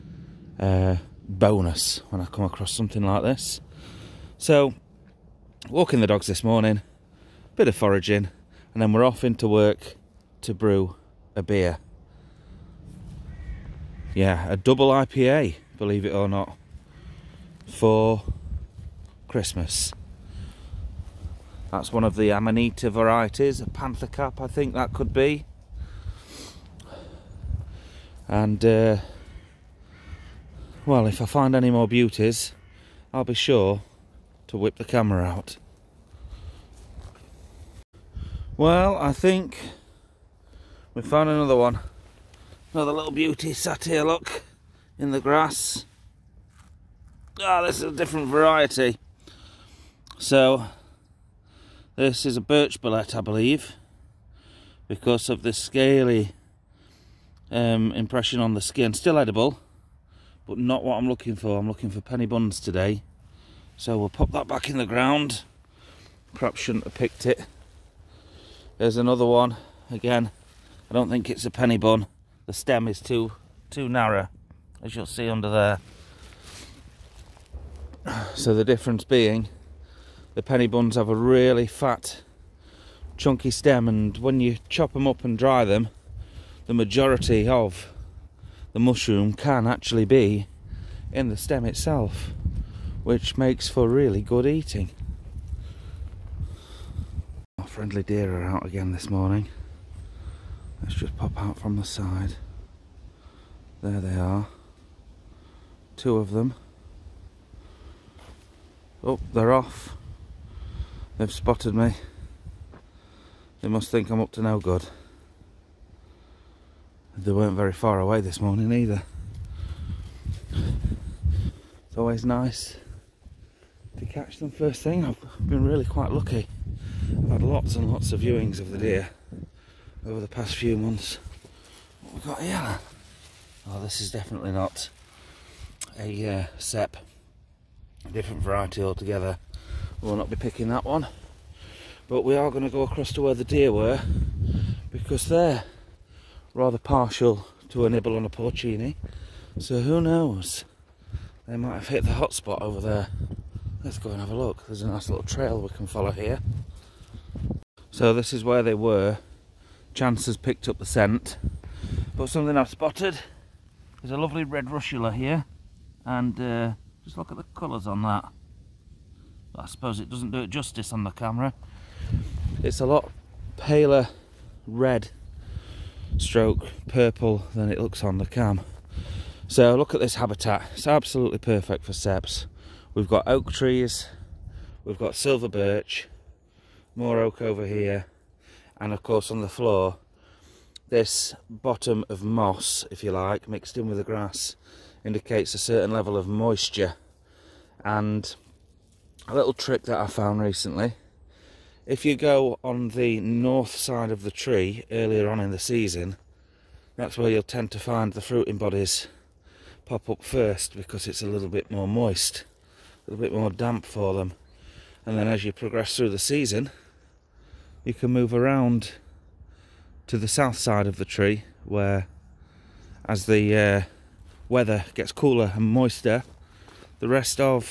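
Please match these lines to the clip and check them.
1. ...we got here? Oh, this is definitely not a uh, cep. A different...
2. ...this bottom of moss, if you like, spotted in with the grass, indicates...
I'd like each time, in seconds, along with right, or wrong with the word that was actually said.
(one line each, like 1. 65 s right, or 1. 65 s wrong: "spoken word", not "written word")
1. 132 s right
2. 190 s wrong: "mixed", not "spotted".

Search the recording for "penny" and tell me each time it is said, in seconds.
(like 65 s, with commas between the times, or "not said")
62 s, 71 s, 80 s.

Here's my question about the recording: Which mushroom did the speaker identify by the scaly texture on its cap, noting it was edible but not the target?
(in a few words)
Birch bolete.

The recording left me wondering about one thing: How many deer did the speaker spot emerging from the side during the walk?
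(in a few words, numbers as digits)
2.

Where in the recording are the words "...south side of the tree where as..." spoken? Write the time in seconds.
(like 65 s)
220 s.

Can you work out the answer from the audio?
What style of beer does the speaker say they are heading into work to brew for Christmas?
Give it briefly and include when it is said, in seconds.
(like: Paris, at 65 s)
Double IPA, at 14 s.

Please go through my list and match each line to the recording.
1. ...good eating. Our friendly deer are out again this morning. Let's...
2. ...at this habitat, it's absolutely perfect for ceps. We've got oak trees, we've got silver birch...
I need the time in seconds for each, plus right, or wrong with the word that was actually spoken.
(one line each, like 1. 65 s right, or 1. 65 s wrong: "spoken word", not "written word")
1. 94 s right
2. 179 s right.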